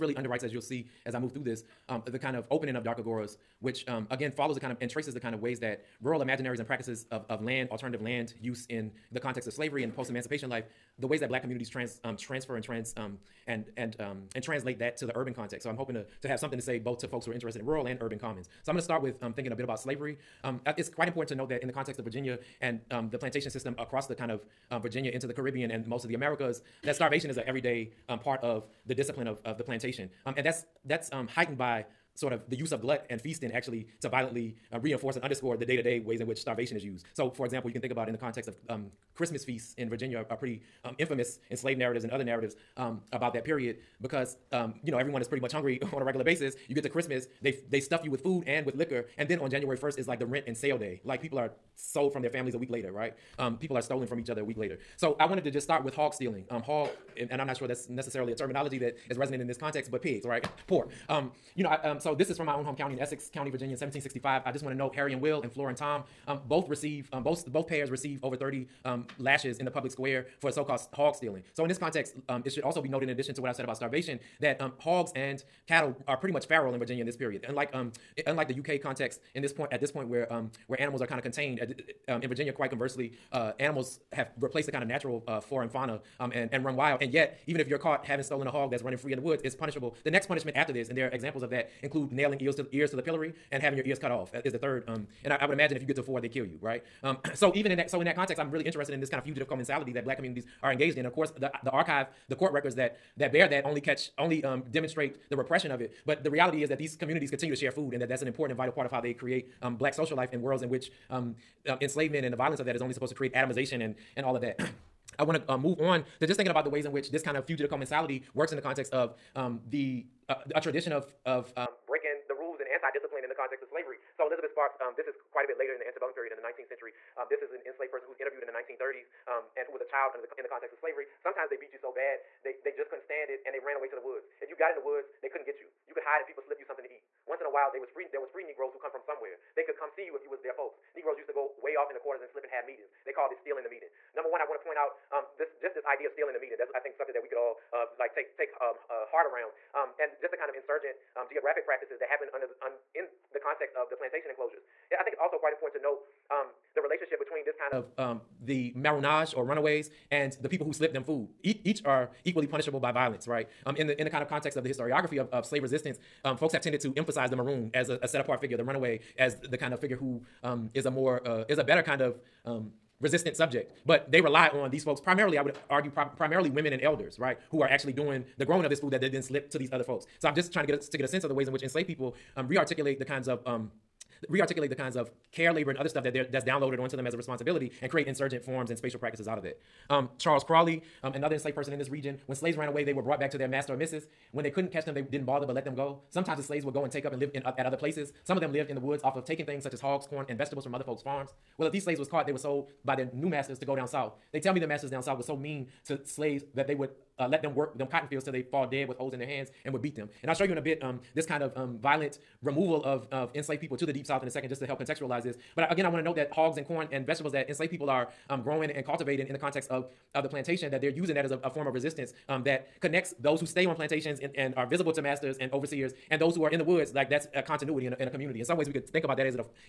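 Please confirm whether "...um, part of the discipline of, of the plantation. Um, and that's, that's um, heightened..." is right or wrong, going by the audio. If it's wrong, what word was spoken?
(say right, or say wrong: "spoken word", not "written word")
right.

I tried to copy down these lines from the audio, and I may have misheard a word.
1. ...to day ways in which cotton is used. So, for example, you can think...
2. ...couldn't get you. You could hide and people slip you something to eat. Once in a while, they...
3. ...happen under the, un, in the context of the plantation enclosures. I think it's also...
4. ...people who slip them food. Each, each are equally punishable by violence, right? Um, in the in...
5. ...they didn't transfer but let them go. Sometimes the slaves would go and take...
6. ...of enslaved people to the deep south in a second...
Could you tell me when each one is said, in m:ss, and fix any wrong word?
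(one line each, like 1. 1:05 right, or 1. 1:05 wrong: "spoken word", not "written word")
1. 0:35 wrong: "starvation", not "cotton"
2. 2:15 right
3. 2:32 right
4. 2:40 right
5. 3:14 wrong: "bother", not "transfer"
6. 3:33 right.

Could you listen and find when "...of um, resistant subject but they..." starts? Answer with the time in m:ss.
2:52.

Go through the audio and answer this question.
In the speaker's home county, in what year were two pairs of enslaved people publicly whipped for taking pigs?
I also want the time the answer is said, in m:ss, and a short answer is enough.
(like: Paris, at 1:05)
1765, at 1:03.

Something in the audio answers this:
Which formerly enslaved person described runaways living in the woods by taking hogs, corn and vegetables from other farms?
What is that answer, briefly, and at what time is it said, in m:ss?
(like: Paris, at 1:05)
Charles Crawley, at 3:10.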